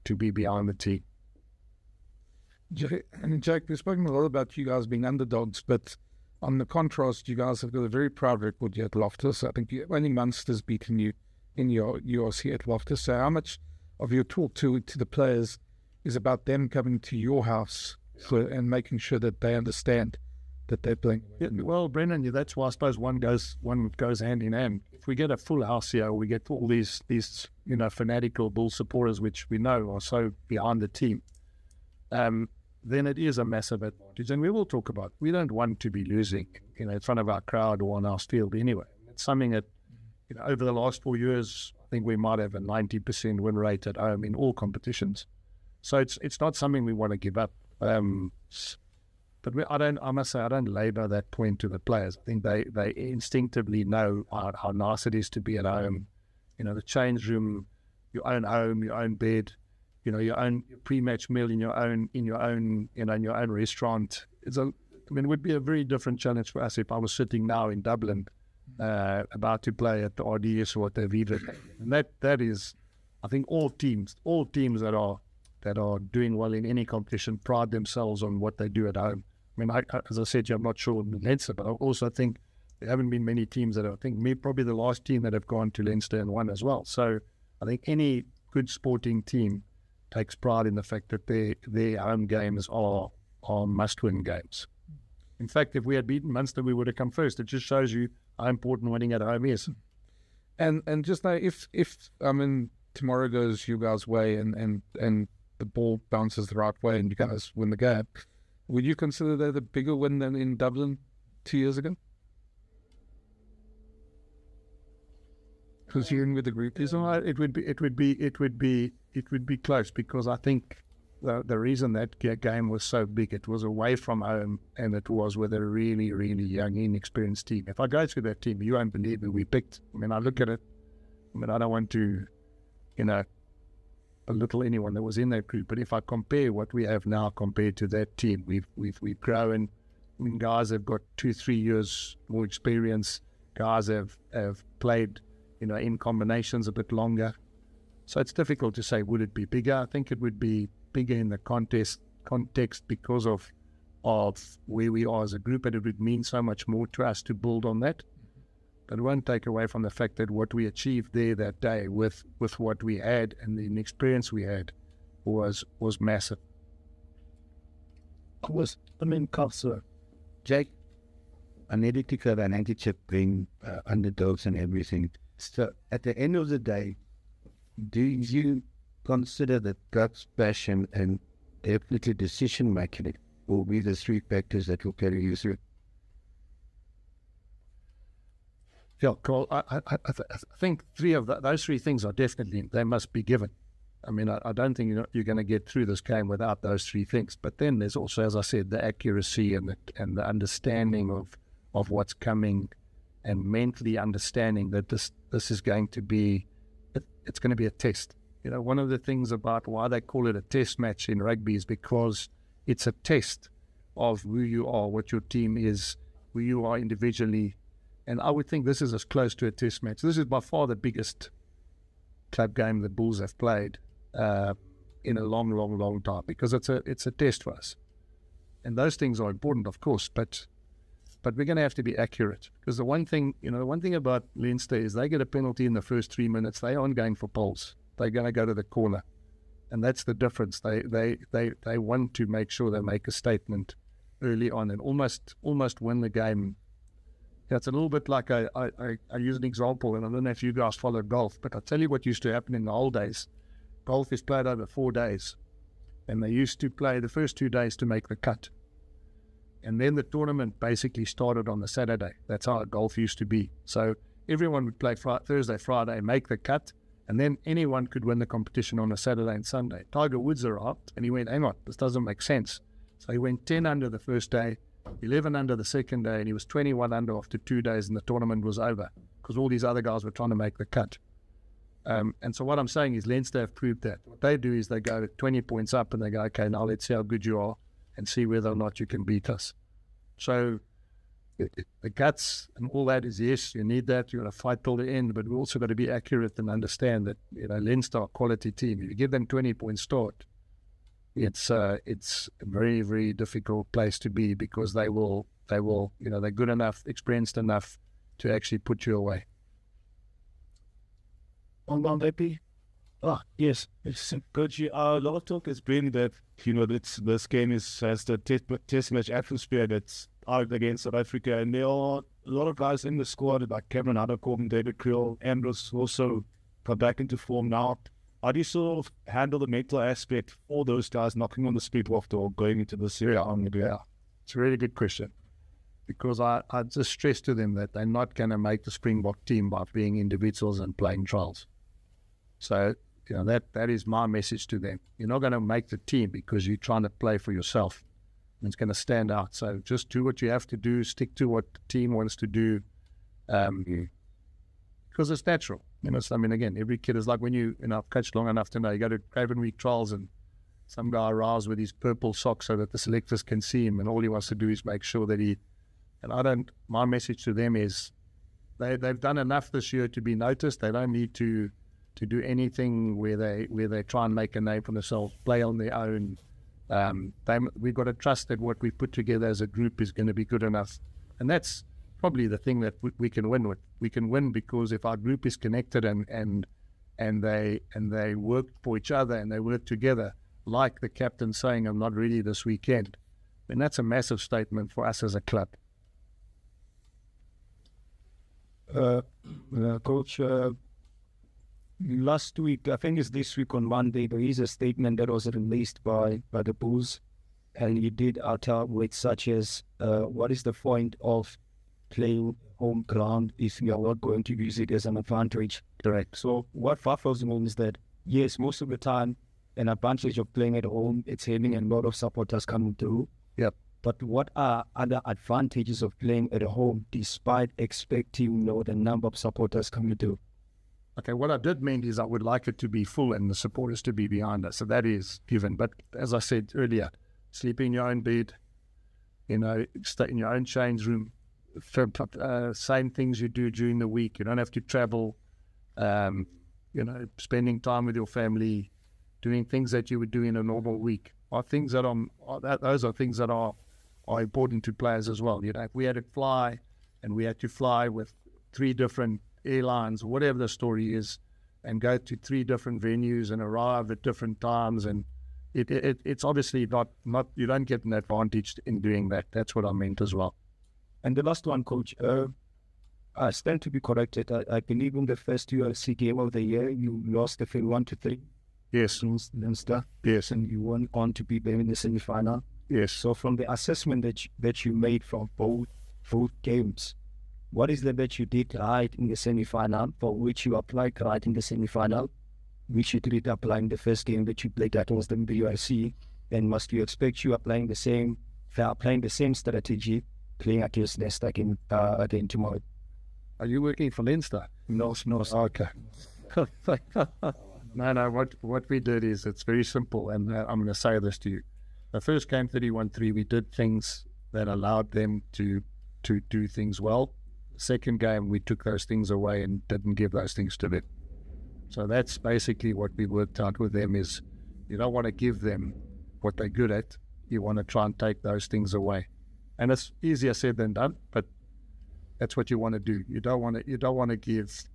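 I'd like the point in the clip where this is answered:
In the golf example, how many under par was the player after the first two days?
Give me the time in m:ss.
4:36.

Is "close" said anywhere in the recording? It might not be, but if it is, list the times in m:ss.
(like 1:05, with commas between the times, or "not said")
1:59, 3:39.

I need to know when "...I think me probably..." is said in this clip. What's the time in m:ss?
1:23.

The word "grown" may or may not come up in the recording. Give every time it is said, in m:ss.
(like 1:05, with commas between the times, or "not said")
2:19.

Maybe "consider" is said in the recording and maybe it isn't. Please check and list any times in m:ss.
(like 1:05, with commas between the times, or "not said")
1:48, 2:59.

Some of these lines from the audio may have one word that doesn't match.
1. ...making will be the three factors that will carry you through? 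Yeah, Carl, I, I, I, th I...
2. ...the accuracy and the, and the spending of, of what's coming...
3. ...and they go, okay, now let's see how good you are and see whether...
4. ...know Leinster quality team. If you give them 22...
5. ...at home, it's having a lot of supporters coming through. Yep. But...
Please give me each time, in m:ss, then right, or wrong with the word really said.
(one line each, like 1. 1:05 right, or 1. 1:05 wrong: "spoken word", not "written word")
1. 3:02 right
2. 3:18 wrong: "understanding", not "spending"
3. 4:45 right
4. 4:57 wrong: "20", not "22"
5. 7:00 right.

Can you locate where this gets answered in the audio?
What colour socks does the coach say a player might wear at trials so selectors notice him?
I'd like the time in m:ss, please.
6:01.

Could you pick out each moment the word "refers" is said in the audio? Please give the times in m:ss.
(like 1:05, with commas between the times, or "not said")
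not said.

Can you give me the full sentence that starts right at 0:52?
I think they they instinctively know how, how nice it is to be at home.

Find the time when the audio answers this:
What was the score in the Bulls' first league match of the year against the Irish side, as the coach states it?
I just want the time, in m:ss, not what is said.
8:32.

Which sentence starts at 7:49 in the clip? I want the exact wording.
That's what I meant as well.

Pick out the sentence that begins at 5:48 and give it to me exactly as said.
And it's going to stand out.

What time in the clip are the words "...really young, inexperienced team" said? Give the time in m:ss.
2:06.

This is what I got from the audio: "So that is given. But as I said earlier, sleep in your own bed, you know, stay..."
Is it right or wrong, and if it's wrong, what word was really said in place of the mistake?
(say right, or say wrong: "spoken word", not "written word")
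right.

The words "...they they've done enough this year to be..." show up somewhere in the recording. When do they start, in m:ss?
6:08.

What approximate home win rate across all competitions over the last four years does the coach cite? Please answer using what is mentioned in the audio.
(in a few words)
90%.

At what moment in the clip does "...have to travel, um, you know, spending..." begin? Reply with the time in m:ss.
7:24.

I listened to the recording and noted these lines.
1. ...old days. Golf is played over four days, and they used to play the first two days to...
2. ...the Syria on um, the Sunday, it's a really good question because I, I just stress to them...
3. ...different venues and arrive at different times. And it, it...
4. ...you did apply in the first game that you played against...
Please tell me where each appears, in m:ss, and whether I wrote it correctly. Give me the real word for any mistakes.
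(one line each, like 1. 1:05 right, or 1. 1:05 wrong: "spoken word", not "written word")
1. 4:12 right
2. 5:32 wrong: "Yeah", not "Sunday"
3. 7:42 right
4. 8:12 right.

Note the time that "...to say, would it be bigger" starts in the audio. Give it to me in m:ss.
2:28.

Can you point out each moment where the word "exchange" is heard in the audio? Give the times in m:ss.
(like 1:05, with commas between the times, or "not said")
not said.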